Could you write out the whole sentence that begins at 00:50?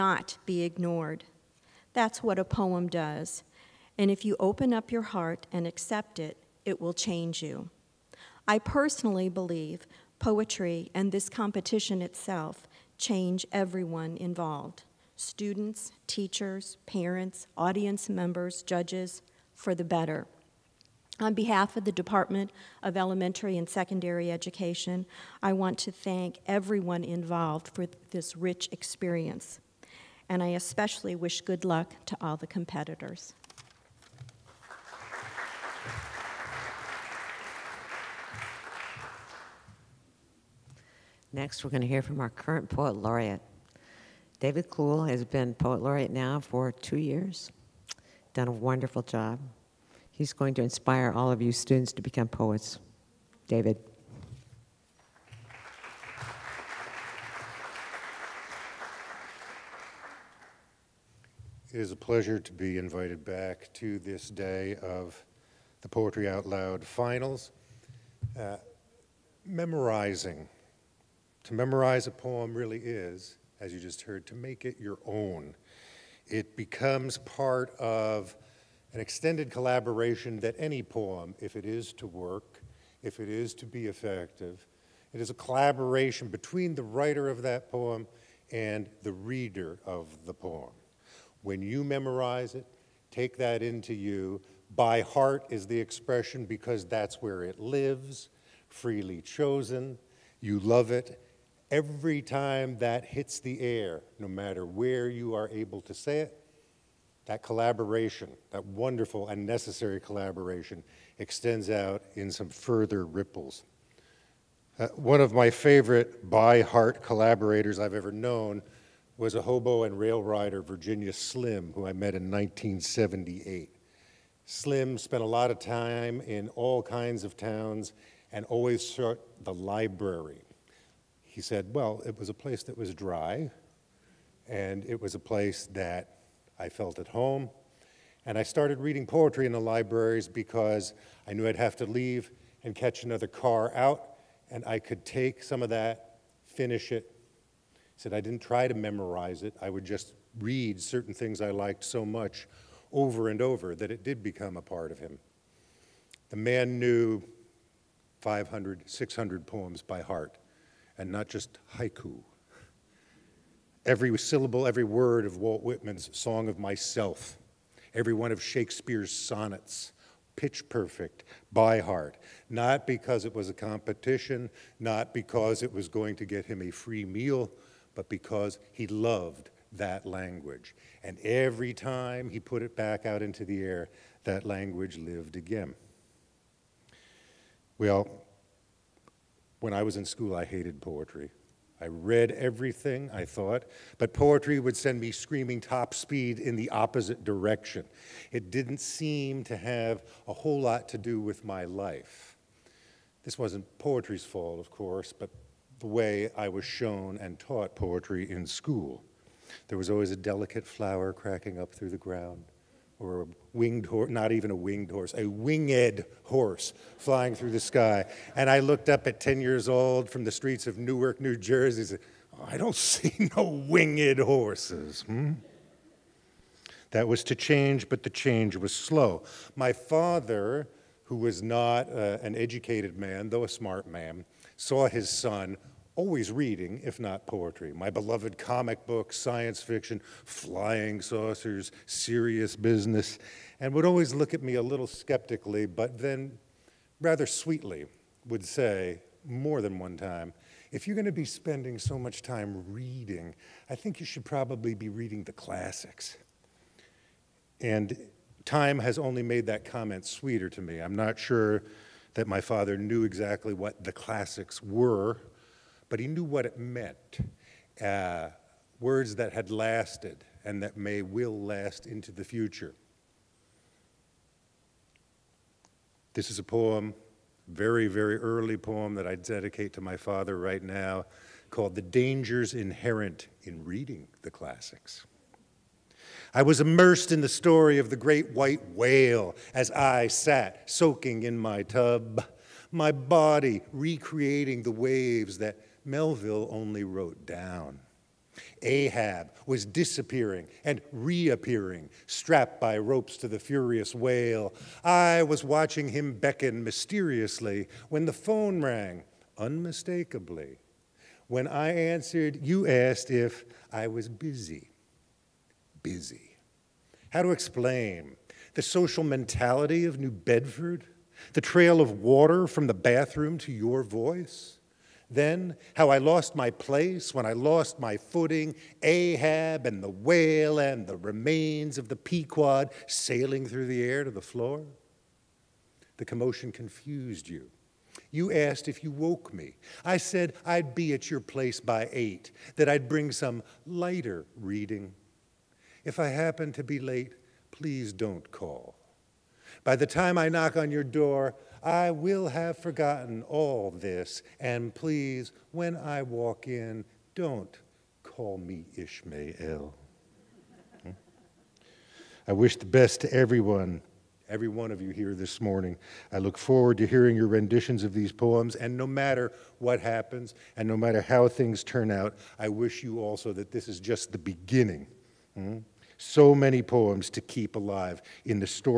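He's going to inspire all of you students to become poets.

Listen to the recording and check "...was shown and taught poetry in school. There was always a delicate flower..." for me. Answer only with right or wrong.
right.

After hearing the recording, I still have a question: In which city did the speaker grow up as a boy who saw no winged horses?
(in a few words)
Newark, New Jersey.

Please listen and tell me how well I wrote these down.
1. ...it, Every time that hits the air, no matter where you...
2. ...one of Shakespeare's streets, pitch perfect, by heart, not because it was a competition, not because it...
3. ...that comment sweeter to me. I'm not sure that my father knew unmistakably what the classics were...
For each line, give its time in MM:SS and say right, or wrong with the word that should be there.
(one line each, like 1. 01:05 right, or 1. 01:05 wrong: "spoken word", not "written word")
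1. 01:40 right
2. 02:48 wrong: "sonnets", not "streets"
3. 04:19 wrong: "exactly", not "unmistakably".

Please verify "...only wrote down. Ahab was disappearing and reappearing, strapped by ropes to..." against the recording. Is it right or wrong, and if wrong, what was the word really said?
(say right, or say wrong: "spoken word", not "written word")
right.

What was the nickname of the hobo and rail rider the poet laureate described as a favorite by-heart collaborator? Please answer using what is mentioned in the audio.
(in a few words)
Virginia Slim.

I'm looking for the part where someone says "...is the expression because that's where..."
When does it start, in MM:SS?
01:35.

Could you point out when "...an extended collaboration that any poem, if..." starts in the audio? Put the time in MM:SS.
01:18.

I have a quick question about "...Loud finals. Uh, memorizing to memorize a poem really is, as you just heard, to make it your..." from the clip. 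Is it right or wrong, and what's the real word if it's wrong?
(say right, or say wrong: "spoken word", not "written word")
right.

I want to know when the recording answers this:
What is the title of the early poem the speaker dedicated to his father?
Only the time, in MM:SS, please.
04:41.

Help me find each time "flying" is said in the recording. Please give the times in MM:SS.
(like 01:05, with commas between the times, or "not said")
03:36, 04:00.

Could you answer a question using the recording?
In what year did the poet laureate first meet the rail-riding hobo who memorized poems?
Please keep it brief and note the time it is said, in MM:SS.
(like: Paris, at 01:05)
1978, at 02:02.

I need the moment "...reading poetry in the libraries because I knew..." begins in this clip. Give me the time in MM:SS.
02:18.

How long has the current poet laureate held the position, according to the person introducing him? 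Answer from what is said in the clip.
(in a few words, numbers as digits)
2 years.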